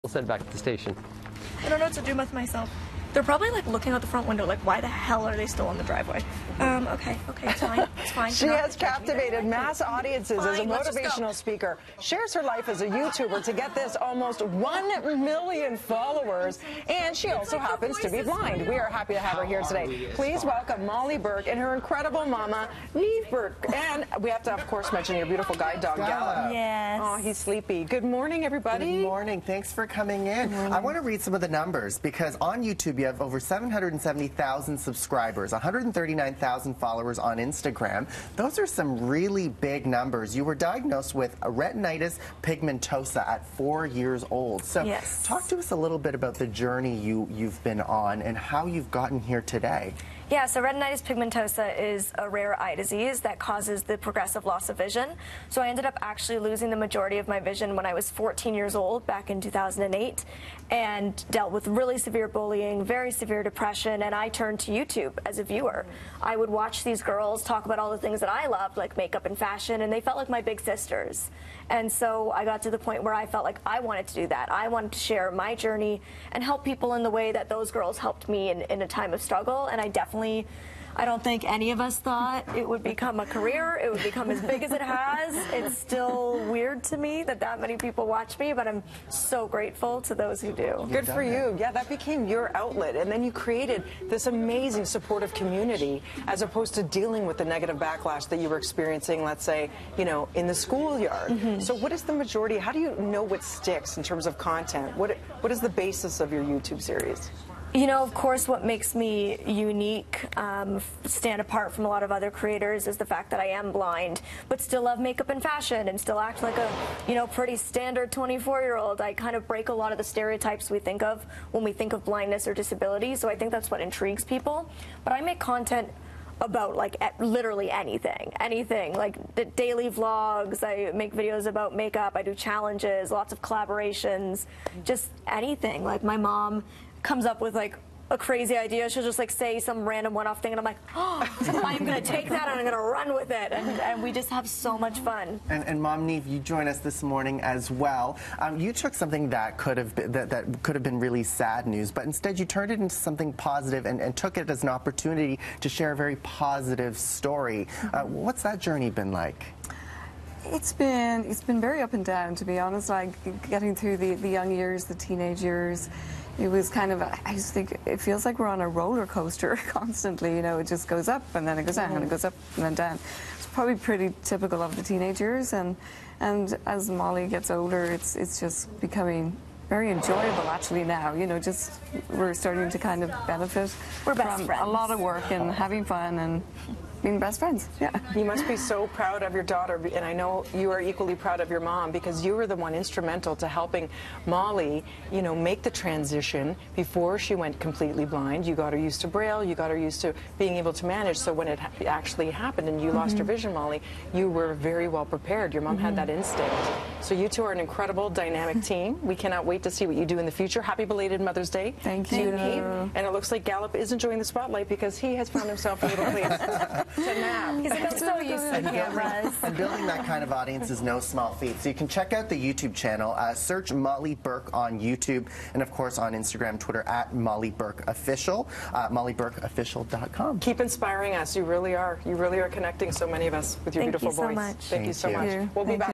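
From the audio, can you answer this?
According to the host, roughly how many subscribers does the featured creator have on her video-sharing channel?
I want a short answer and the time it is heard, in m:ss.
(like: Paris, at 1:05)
770,000, at 0:33.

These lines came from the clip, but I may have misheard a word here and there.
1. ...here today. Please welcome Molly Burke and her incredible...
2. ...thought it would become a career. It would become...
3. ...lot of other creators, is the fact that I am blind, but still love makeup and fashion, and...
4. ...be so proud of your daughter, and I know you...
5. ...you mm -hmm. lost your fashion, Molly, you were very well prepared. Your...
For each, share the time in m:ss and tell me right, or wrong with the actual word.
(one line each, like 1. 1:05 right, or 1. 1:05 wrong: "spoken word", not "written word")
1. 0:19 right
2. 1:21 right
3. 1:51 right
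4. 3:08 right
5. 3:22 wrong: "vision", not "fashion".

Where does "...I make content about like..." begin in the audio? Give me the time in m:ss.
2:05.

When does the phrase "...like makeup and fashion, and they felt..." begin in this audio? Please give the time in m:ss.
1:08.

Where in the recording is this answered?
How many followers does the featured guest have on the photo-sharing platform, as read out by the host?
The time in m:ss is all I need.
0:35.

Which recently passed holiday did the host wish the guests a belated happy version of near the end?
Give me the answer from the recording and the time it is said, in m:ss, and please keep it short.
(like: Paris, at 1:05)
Mother's Day, at 3:31.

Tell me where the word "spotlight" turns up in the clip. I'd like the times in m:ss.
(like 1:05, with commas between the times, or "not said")
3:34.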